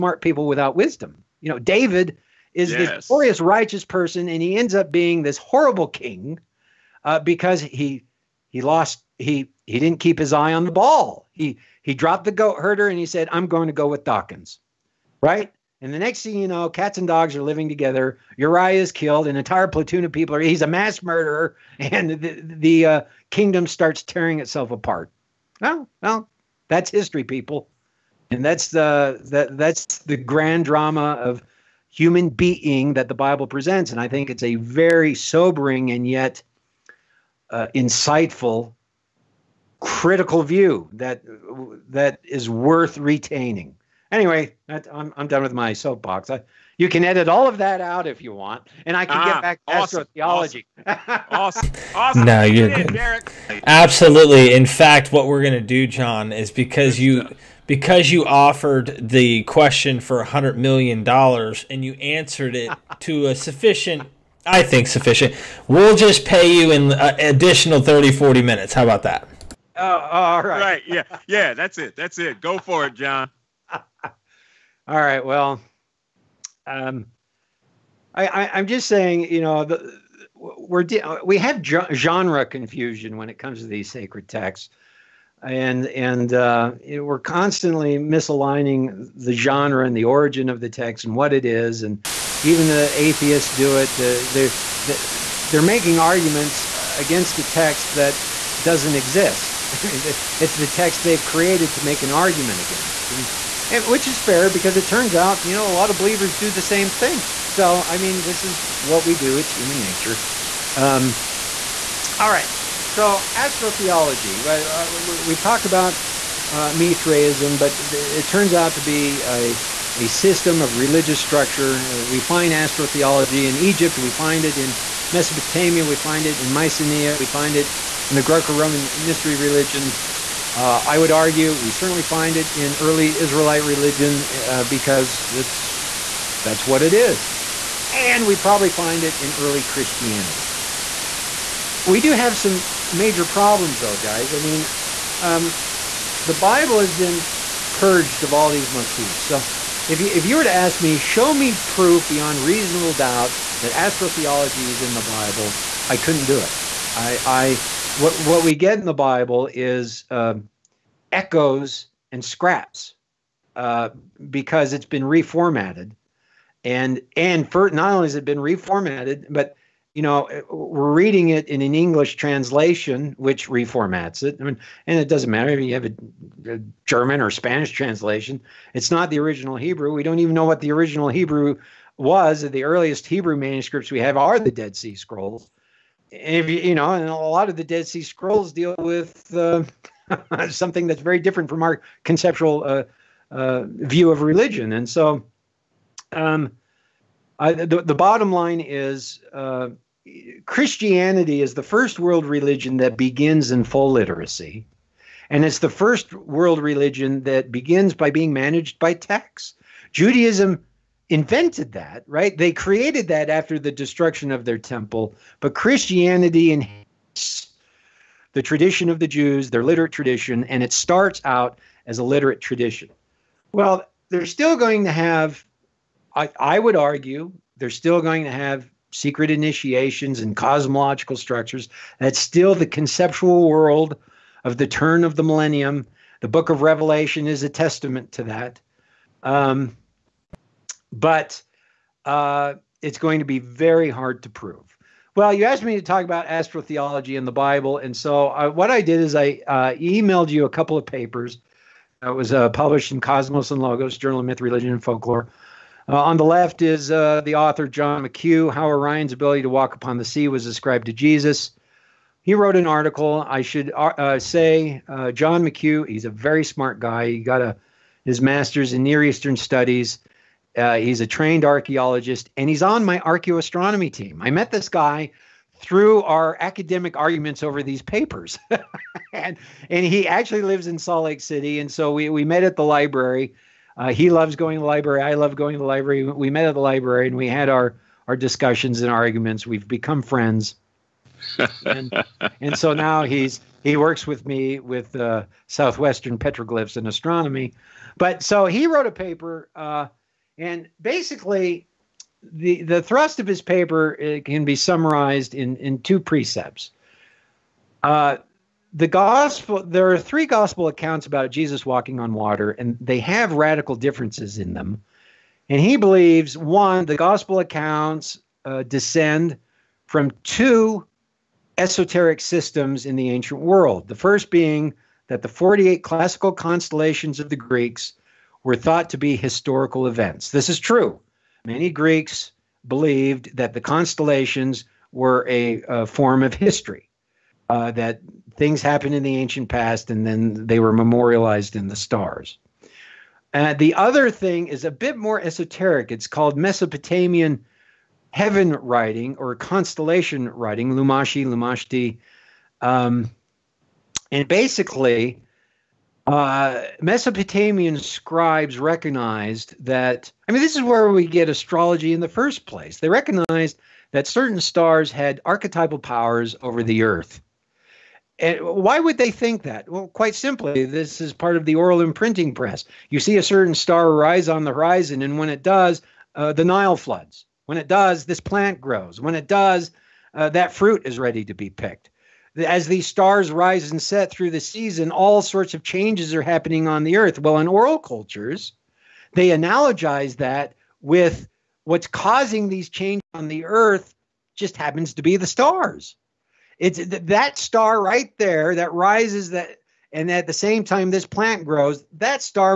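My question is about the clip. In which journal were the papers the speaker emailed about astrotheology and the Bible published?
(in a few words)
Cosmos and Logos.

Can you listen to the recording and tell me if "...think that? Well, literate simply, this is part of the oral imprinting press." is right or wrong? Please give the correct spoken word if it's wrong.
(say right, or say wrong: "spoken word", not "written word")
wrong: "quite", not "literate".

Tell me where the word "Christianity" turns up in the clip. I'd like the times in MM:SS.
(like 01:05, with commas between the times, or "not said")
02:19, 03:20, 03:35.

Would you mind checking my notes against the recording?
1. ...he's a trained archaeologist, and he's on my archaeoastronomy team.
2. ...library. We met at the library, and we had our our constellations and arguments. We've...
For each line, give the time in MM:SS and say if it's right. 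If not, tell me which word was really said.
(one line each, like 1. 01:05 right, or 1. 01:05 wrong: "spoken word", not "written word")
1. 04:30 right
2. 04:45 wrong: "discussions", not "constellations".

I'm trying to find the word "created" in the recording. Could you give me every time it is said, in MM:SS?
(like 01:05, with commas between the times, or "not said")
01:41, 03:32.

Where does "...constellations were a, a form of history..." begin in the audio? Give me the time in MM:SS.
05:33.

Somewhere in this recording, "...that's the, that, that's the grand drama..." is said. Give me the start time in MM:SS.
00:28.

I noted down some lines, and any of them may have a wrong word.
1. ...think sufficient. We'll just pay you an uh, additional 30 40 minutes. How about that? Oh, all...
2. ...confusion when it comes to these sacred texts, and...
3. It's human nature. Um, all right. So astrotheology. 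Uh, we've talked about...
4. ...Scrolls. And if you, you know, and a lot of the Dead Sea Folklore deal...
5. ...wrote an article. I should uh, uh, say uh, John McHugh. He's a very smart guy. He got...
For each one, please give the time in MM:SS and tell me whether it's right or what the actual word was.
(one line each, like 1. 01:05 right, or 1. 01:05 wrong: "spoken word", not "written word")
1. 01:04 right
2. 01:22 right
3. 01:49 right
4. 03:04 wrong: "Scrolls", not "Folklore"
5. 04:22 right.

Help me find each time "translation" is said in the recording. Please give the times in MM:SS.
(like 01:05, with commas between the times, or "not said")
02:52, 02:57.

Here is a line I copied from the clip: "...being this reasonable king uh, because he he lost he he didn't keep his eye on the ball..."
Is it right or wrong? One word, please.
wrong.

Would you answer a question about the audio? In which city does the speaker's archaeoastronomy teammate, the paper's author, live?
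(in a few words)
Salt Lake City.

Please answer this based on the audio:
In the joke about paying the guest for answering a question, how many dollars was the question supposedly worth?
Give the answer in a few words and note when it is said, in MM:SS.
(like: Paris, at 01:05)
100 million, at 01:00.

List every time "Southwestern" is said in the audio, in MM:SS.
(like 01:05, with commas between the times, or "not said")
04:55.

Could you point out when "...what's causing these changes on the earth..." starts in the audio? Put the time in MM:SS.
06:31.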